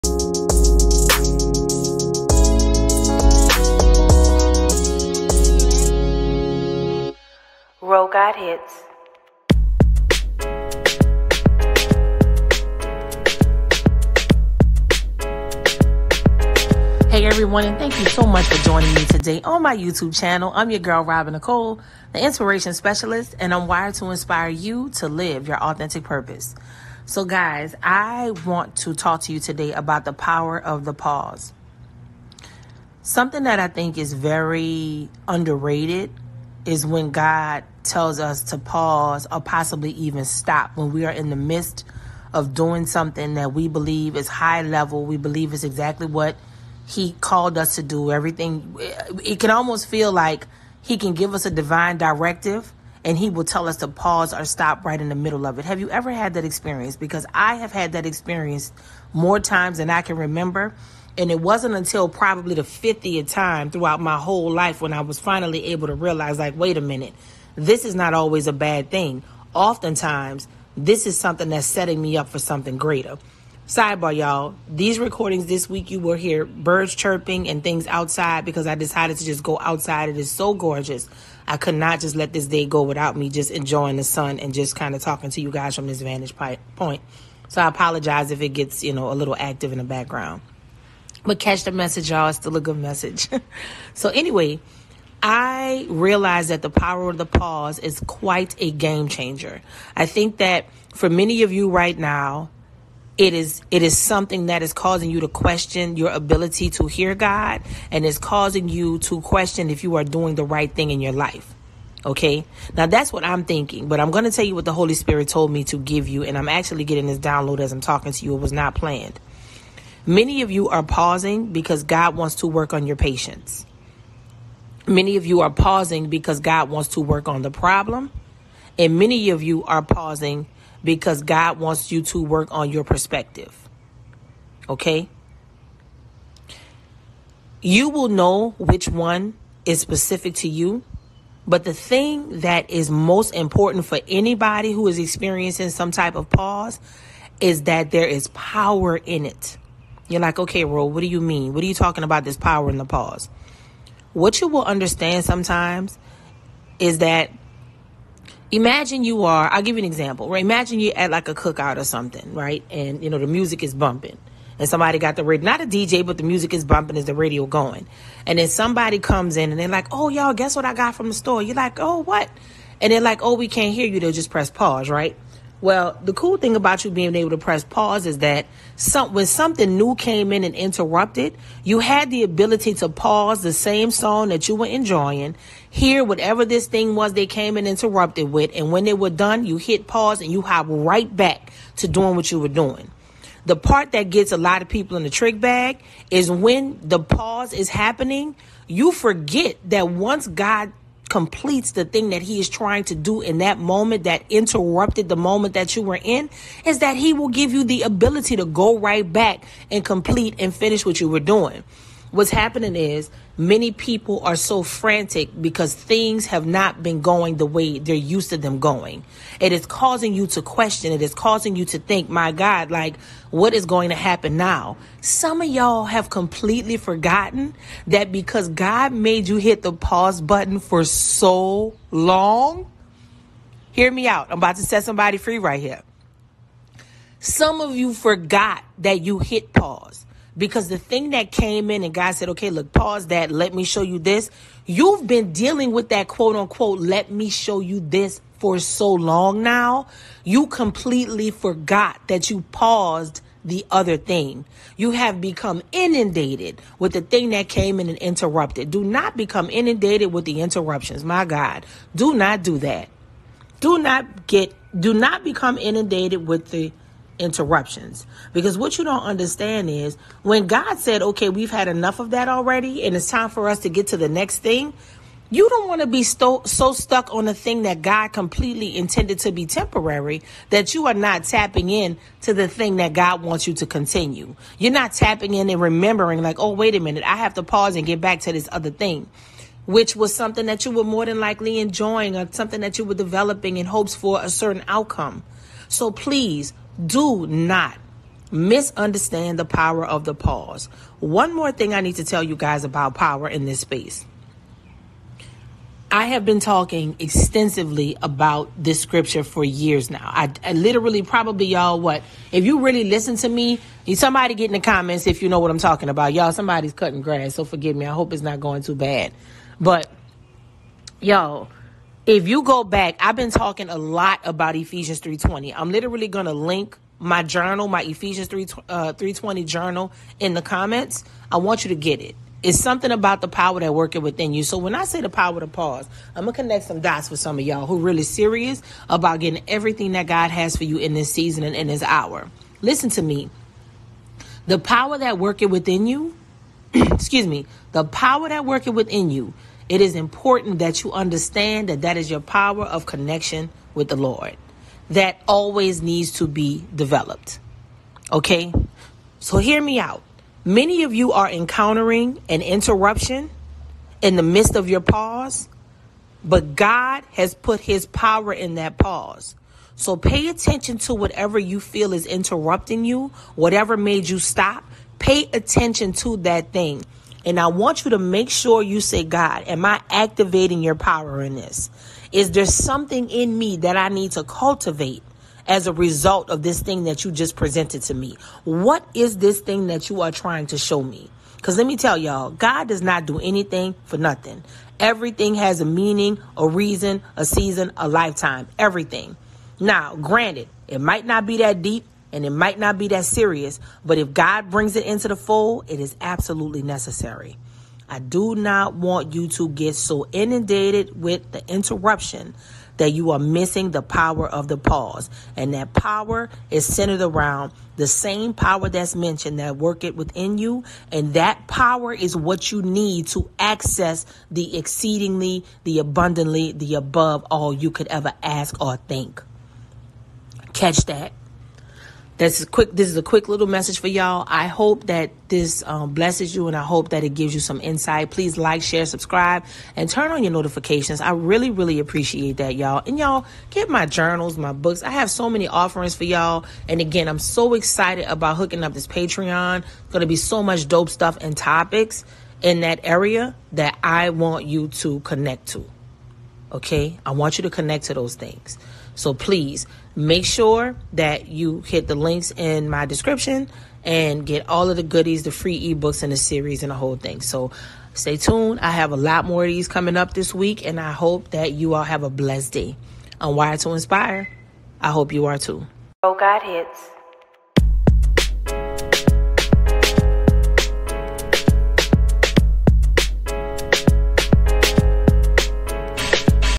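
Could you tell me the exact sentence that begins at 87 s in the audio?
So I apologize if it gets, you know, a little active in the background.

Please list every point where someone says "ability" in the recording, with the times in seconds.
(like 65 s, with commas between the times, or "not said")
106 s, 182 s, 207 s.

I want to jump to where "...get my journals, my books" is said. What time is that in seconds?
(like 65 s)
443 s.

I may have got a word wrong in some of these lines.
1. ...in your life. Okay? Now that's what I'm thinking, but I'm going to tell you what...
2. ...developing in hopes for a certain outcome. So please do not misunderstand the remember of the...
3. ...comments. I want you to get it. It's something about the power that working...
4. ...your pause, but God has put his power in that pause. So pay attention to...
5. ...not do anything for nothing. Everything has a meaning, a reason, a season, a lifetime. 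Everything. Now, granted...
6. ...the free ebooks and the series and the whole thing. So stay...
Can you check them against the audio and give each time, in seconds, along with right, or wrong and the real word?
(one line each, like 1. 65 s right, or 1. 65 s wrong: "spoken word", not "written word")
1. 110 s right
2. 292 s wrong: "power", not "remember"
3. 330 s right
4. 364 s right
5. 392 s right
6. 465 s right.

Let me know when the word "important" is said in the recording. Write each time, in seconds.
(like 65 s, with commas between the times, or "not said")
143 s, 349 s.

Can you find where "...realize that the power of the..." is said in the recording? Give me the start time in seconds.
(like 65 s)
95 s.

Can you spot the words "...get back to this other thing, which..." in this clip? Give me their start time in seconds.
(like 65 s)
287 s.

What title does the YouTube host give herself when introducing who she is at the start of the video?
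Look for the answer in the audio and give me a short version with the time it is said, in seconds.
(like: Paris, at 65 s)
the inspiration specialist, at 22 s.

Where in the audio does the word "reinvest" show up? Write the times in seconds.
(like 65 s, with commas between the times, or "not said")
not said.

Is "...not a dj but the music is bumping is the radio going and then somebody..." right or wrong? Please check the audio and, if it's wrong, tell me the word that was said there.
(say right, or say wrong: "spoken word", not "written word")
right.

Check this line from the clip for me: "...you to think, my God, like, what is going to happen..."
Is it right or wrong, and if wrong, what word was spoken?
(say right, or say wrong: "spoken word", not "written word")
right.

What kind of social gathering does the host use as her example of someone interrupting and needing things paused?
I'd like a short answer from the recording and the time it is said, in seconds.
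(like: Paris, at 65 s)
a cookout, at 161 s.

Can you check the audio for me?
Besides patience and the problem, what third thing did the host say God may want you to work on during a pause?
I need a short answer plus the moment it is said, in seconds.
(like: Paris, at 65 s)
perspective, at 132 s.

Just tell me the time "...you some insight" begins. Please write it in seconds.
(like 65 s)
437 s.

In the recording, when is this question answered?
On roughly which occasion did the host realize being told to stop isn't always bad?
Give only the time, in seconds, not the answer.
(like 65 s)
62 s.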